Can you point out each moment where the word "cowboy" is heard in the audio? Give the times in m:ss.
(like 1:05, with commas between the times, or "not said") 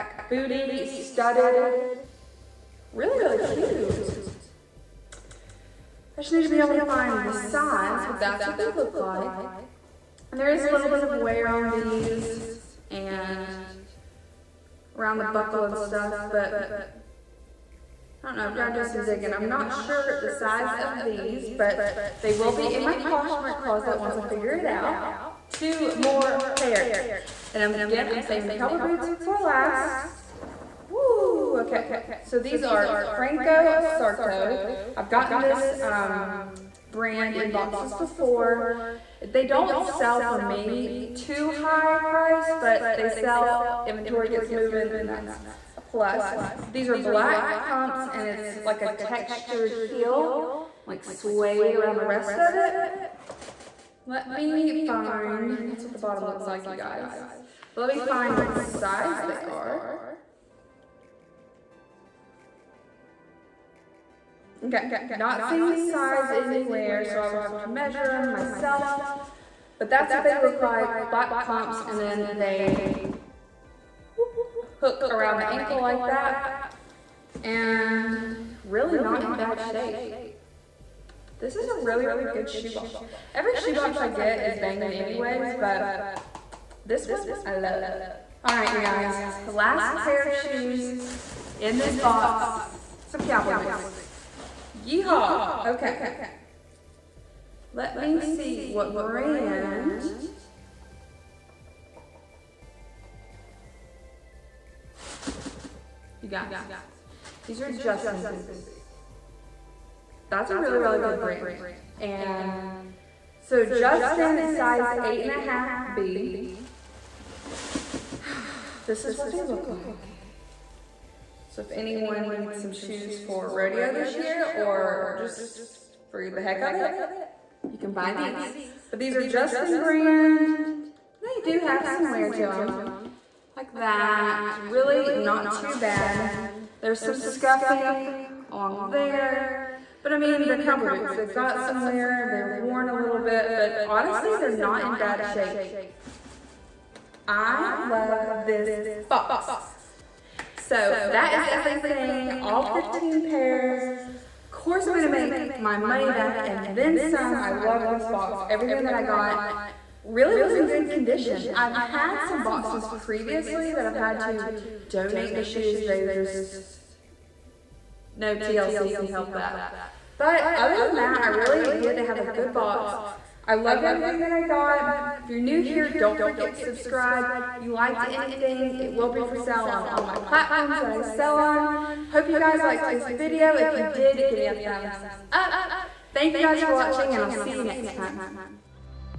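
0:28, 1:33, 2:20.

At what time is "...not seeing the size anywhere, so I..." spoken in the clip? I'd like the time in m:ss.
1:05.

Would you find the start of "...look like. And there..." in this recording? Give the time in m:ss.
0:08.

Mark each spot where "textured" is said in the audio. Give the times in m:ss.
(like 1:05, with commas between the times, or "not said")
0:48.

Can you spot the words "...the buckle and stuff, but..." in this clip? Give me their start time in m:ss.
0:15.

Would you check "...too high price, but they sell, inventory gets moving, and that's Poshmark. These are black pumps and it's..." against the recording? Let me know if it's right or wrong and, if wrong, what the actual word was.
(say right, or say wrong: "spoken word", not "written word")
wrong: "Plus", not "Poshmark".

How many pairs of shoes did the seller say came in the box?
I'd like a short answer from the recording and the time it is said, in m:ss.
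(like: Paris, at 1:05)
15, at 2:32.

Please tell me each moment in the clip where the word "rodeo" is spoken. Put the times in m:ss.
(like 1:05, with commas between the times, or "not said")
2:03.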